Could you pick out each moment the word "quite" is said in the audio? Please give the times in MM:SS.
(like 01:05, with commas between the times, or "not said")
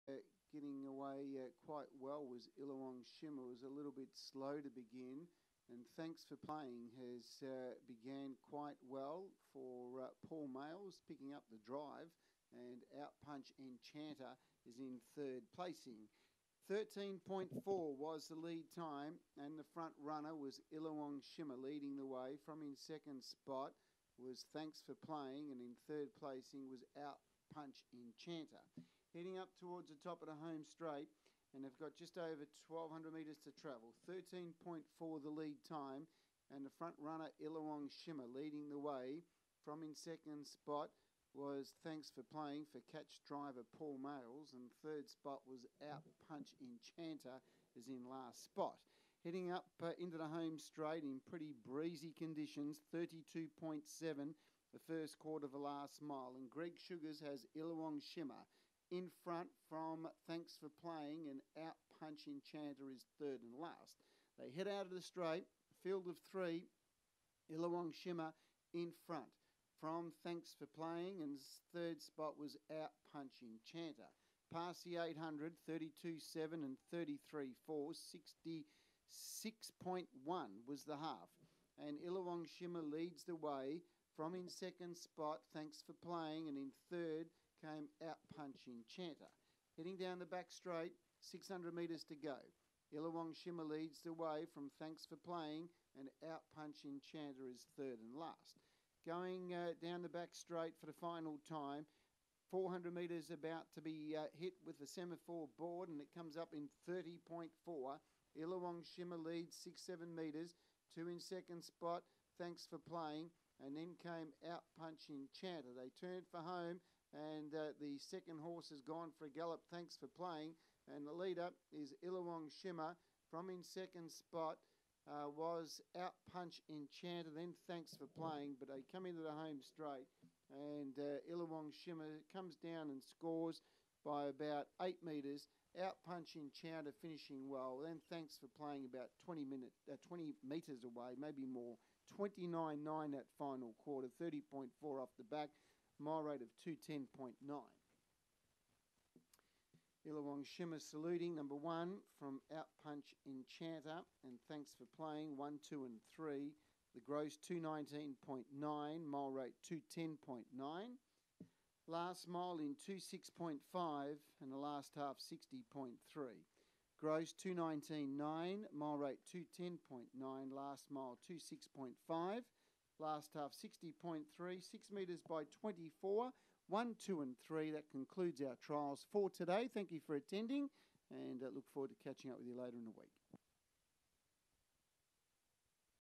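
00:01, 00:08.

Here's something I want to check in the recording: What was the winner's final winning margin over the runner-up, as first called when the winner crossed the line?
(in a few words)
About 8 metres.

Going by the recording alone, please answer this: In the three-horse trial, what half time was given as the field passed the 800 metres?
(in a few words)
66.1.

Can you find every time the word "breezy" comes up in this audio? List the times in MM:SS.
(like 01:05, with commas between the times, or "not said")
00:51.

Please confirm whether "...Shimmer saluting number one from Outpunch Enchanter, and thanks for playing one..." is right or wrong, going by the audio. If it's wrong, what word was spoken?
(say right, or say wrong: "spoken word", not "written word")
right.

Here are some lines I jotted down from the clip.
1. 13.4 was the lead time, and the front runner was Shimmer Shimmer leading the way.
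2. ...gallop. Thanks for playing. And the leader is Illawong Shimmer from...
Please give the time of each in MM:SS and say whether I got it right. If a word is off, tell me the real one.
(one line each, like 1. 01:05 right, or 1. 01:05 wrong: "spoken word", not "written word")
1. 00:16 wrong: "Illawong", not "Shimmer"
2. 01:59 right.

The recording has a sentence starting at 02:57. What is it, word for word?
That concludes our trials for today.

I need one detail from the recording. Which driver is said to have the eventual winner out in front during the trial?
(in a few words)
Greg Sugars.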